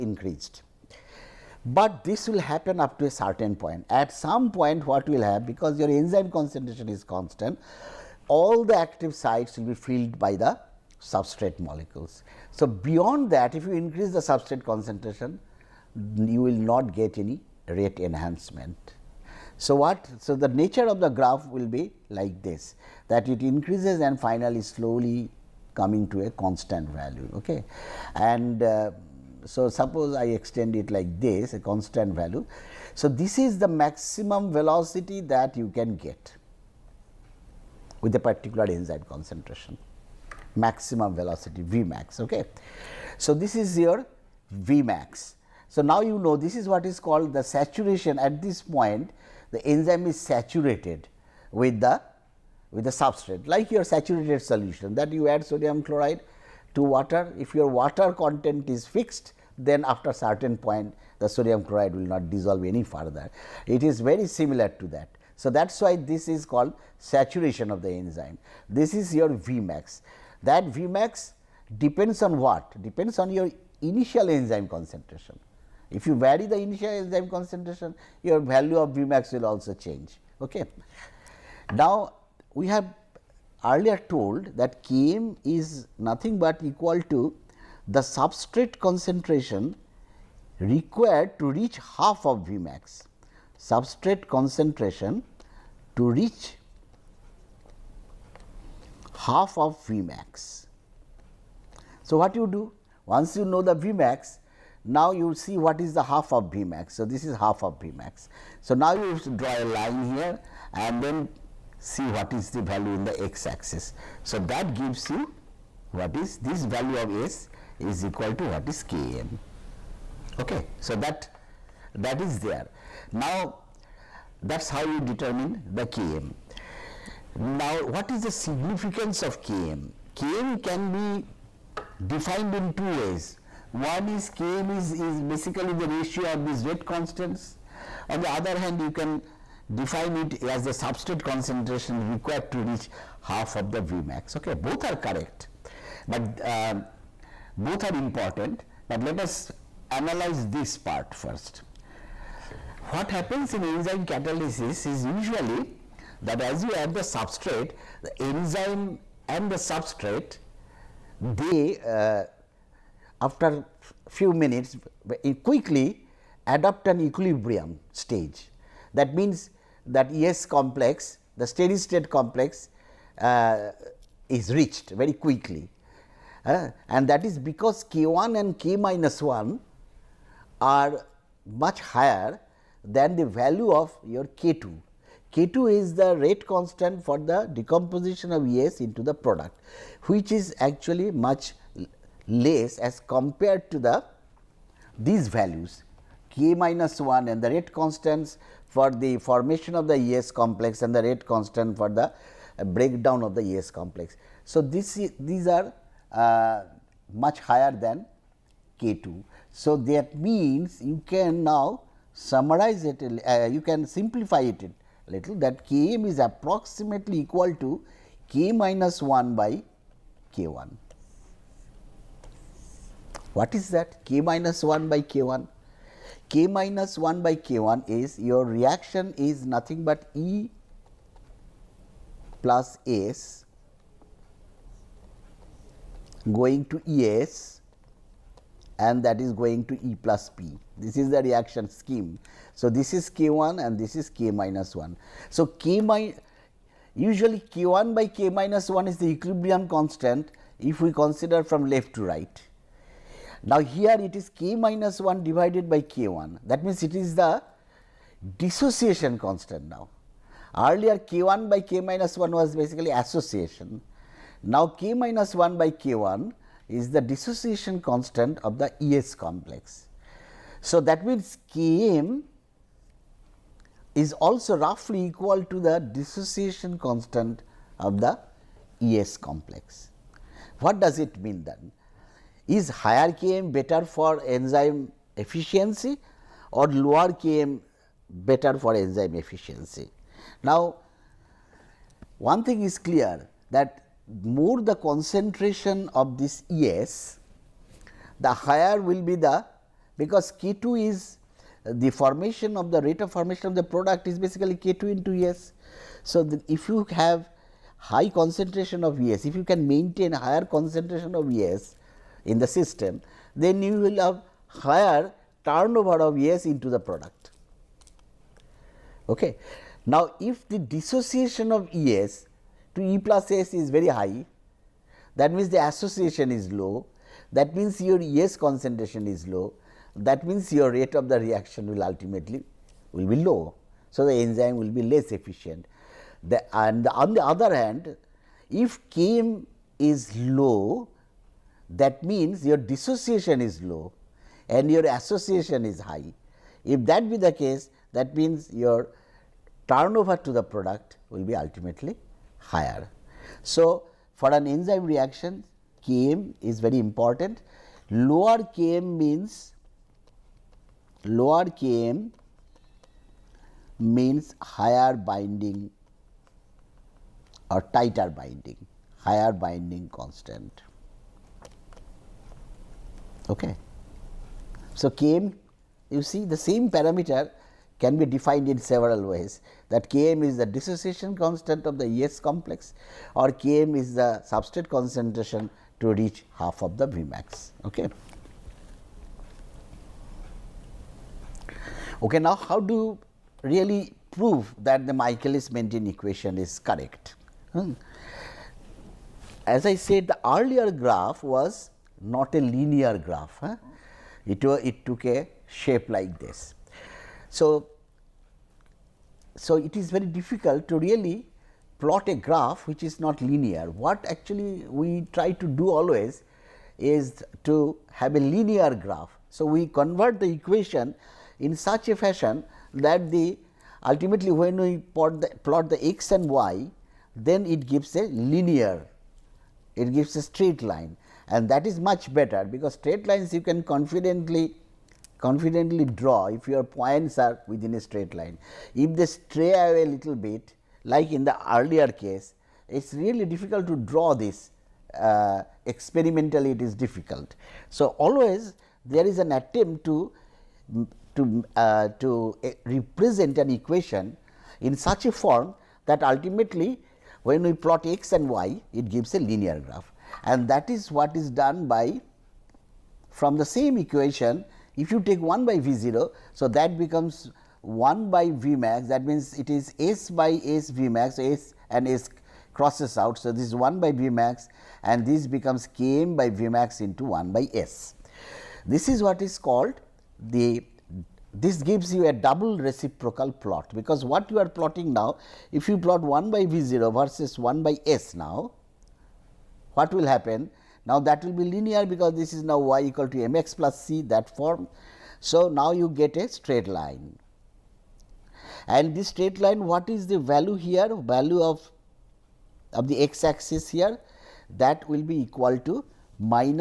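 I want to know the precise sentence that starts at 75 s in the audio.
If you vary the initial enzyme concentration, your value of V max will also change.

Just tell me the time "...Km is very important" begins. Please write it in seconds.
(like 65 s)
355 s.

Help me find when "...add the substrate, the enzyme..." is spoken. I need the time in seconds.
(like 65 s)
156 s.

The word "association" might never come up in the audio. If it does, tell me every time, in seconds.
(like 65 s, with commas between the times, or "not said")
262 s, 325 s, 344 s.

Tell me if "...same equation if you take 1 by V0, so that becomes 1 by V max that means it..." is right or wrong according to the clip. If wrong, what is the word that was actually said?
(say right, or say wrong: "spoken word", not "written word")
right.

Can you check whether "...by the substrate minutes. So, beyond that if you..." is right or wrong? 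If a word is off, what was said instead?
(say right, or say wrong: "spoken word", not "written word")
wrong: "molecules", not "minutes".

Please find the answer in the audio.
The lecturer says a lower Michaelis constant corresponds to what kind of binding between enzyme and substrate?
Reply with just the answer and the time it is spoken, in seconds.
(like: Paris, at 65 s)
tighter binding, at 367 s.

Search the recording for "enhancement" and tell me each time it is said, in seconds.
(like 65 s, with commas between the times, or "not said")
17 s.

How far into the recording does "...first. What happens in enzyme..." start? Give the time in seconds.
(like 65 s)
151 s.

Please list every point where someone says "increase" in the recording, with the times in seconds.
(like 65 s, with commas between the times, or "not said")
13 s, 23 s.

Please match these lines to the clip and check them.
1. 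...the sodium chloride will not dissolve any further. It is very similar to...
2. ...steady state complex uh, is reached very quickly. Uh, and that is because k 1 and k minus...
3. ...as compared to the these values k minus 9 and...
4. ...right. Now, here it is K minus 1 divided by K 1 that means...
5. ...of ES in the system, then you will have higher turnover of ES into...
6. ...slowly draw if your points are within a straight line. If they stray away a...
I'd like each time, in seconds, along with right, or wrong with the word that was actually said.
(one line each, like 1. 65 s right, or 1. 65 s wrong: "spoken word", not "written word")
1. 61 s right
2. 171 s right
3. 192 s wrong: "1", not "9"
4. 252 s right
5. 311 s right
6. 435 s wrong: "confidently", not "slowly".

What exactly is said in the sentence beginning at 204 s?
So, this these are uh, much higher than k 2.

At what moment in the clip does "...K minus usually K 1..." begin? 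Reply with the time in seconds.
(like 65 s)
245 s.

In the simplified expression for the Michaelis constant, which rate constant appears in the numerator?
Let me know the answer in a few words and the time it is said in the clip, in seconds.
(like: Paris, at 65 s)
k minus 1, at 215 s.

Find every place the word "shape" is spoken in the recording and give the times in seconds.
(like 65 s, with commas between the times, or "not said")
405 s.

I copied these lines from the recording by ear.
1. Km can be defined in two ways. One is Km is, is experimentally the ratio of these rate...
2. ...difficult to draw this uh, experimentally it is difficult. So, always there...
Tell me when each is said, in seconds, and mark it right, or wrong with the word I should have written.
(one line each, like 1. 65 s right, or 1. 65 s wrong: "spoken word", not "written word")
1. 130 s wrong: "basically", not "experimentally"
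2. 443 s right.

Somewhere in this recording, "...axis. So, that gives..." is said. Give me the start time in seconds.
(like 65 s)
113 s.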